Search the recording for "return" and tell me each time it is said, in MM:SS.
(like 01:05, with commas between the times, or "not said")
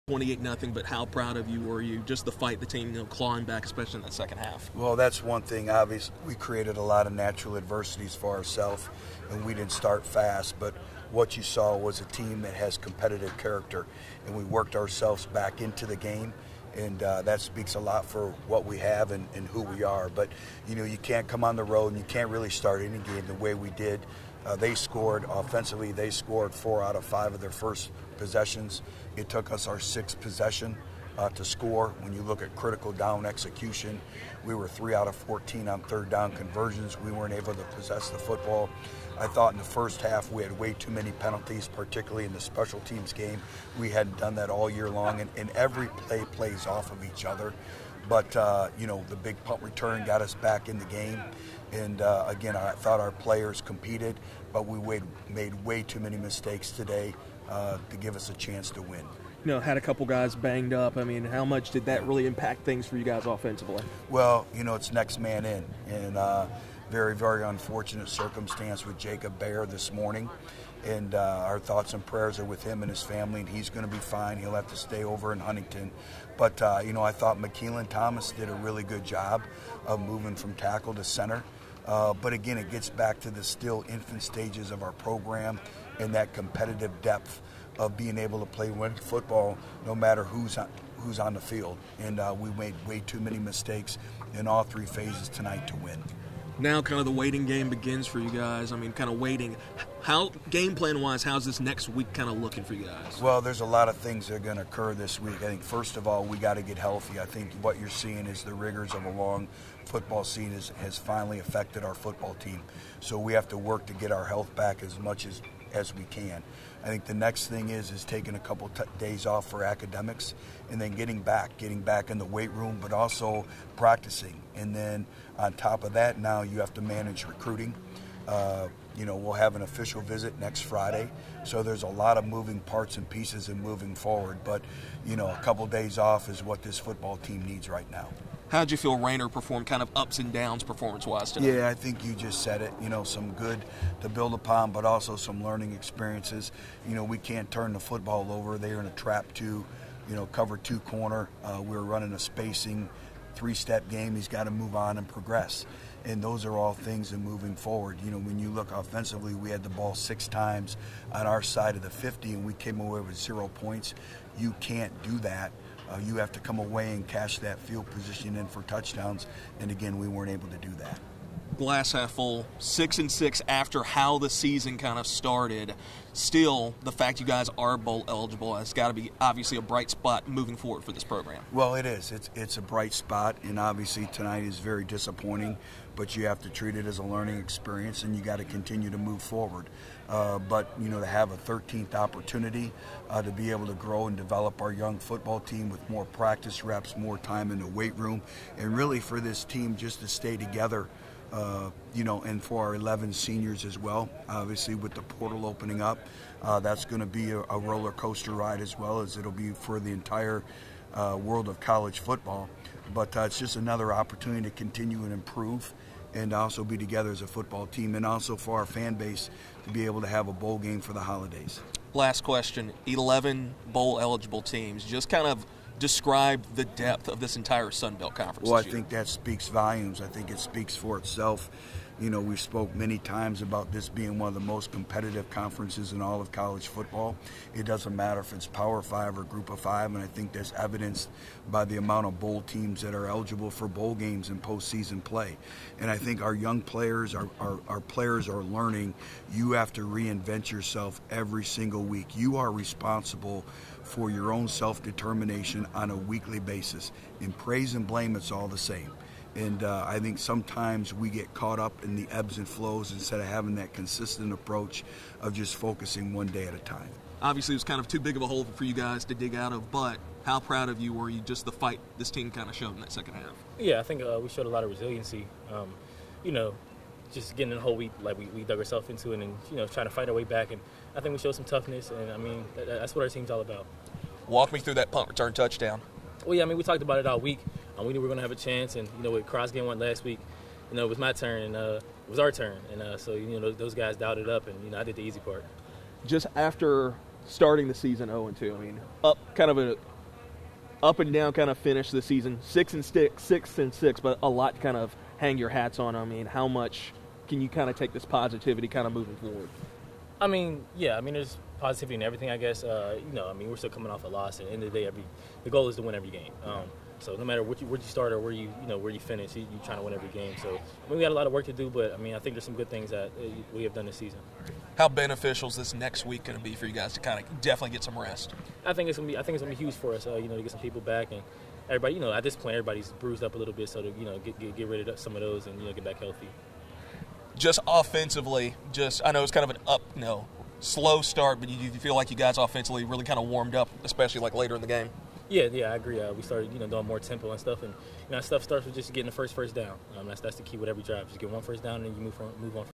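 00:49, 04:45.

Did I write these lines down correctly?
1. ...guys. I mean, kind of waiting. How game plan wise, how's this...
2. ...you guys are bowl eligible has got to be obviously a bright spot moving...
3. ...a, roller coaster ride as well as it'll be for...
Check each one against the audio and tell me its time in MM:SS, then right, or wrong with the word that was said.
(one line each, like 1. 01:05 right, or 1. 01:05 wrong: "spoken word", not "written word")
1. 01:38 right
2. 02:57 right
3. 03:27 right.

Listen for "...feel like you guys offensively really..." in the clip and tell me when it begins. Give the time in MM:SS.
05:41.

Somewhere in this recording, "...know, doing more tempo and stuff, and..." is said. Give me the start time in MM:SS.
05:46.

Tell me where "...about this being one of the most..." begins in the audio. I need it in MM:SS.
03:53.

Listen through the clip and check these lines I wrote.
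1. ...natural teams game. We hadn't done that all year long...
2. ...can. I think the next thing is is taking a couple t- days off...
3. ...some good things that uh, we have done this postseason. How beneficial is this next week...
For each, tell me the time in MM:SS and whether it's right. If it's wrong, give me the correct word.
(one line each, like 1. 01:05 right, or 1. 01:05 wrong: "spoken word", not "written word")
1. 00:42 wrong: "special", not "natural"
2. 01:56 right
3. 05:22 wrong: "season", not "postseason".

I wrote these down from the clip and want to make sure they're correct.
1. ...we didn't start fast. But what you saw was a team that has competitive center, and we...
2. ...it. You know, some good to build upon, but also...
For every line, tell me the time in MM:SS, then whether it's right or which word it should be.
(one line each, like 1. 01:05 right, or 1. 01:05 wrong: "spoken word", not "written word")
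1. 00:09 wrong: "character", not "center"
2. 02:22 right.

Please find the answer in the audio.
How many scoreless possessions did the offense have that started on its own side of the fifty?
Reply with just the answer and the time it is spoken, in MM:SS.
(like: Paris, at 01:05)
6, at 02:39.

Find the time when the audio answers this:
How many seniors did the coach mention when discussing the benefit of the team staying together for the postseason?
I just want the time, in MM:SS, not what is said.
03:22.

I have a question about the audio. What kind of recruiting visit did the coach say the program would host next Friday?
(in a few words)
official visit.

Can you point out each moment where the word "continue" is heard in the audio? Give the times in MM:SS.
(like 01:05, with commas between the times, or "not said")
03:08, 03:34.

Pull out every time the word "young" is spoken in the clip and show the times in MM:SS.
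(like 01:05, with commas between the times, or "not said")
03:14, 04:06.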